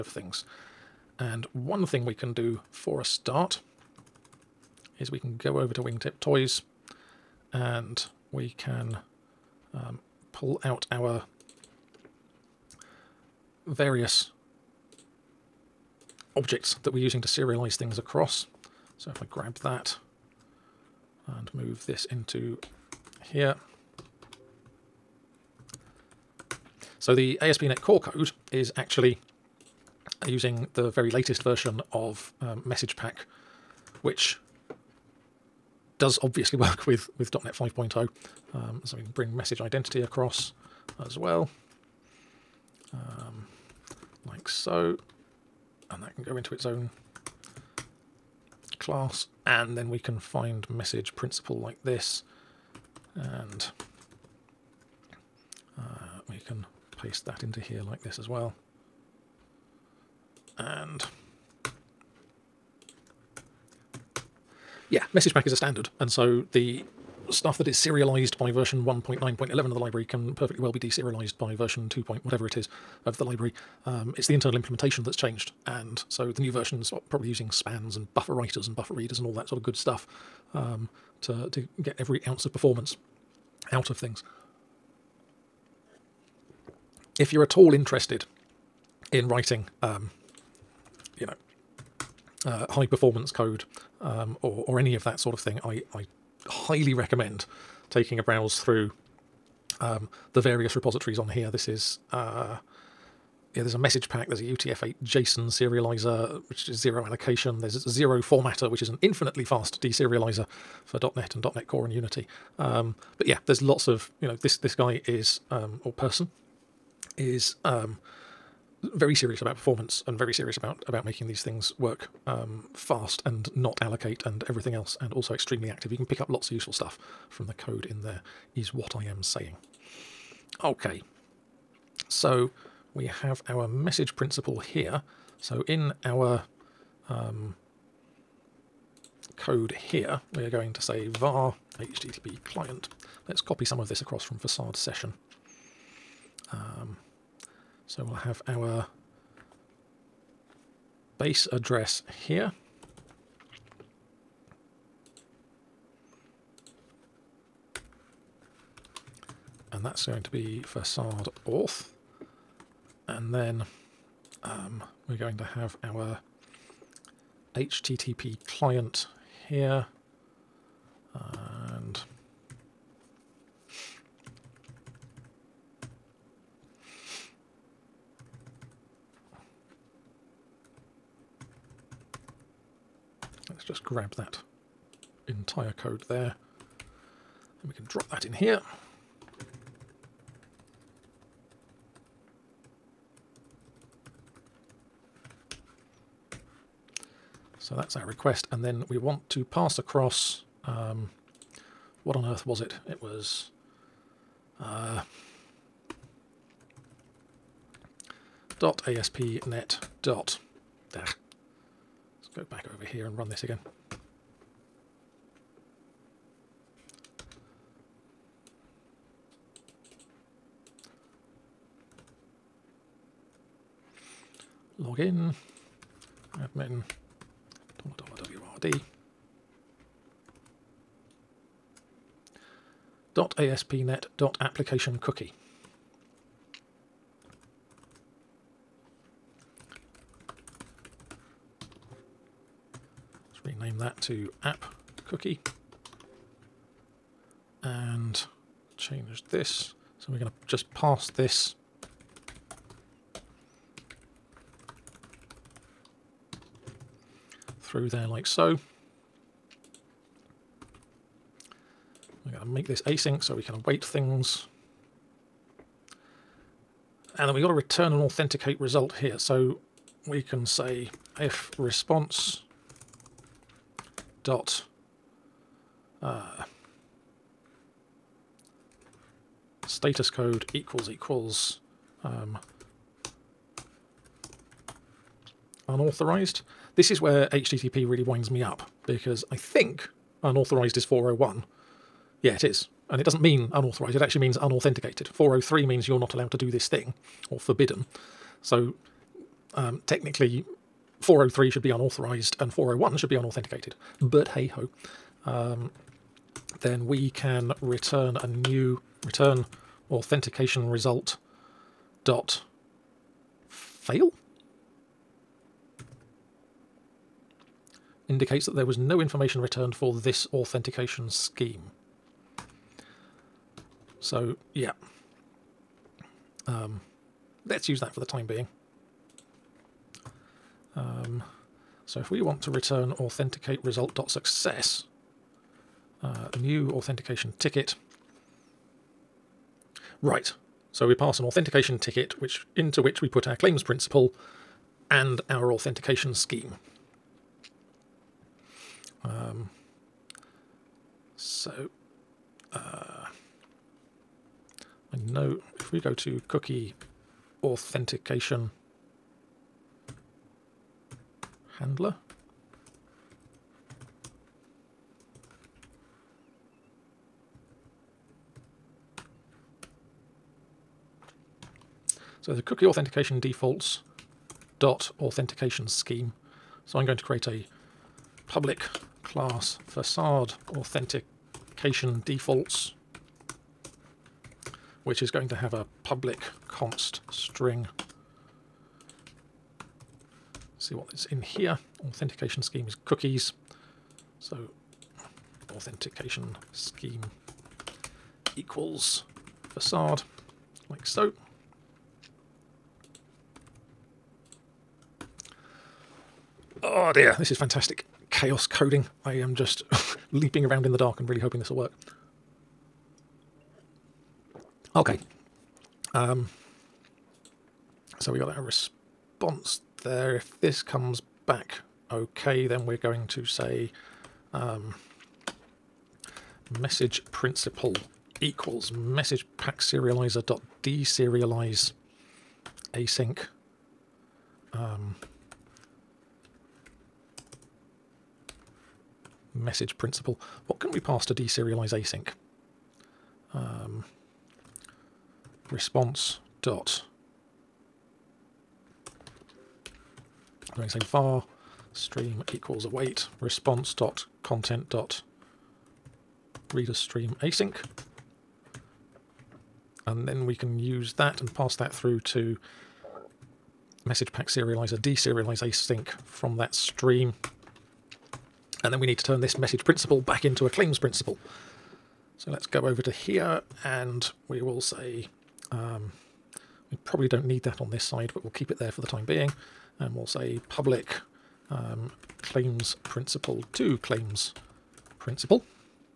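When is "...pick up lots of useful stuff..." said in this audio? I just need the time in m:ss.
2:06.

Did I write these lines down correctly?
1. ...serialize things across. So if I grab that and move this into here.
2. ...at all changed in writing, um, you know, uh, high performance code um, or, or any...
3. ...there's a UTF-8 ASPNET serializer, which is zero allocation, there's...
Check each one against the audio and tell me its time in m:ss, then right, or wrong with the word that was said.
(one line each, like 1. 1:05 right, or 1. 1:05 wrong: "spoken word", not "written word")
1. 0:17 right
2. 1:27 wrong: "interested", not "changed"
3. 1:44 wrong: "JSON", not "ASPNET".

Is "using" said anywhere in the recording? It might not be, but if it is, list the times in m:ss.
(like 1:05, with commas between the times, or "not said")
0:17, 0:30, 1:17.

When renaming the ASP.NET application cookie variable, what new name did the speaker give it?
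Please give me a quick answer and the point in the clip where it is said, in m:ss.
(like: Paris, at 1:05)
app cookie, at 4:04.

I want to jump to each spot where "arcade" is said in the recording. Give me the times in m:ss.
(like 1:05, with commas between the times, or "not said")
not said.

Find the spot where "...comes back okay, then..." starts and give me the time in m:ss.
7:00.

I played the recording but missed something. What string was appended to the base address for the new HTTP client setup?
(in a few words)
facade auth.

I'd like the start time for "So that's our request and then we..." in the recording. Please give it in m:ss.
3:17.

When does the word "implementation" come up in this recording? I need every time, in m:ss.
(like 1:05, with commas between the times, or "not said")
1:14.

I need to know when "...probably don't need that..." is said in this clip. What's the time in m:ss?
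7:56.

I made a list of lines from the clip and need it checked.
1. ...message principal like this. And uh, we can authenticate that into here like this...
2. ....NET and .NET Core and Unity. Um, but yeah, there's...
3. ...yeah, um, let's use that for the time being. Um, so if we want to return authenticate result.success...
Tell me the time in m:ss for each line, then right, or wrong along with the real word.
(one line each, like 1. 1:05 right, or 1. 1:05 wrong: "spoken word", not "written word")
1. 0:50 wrong: "paste", not "authenticate"
2. 1:51 right
3. 5:24 right.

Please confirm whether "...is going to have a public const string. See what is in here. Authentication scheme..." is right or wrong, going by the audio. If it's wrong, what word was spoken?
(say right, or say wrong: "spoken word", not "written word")
right.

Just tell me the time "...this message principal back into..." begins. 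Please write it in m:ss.
7:49.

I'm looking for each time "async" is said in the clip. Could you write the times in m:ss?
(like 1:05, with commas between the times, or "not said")
4:22, 7:12, 7:21, 7:37, 7:45.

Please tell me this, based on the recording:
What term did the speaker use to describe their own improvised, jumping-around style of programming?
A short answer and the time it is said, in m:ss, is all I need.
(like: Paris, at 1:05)
Chaos coding, at 6:48.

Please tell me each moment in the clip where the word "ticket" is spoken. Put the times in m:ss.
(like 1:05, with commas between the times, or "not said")
5:37, 5:41.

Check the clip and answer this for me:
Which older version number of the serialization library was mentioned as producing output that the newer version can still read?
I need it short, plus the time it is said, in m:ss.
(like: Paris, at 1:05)
1.9.11, at 1:08.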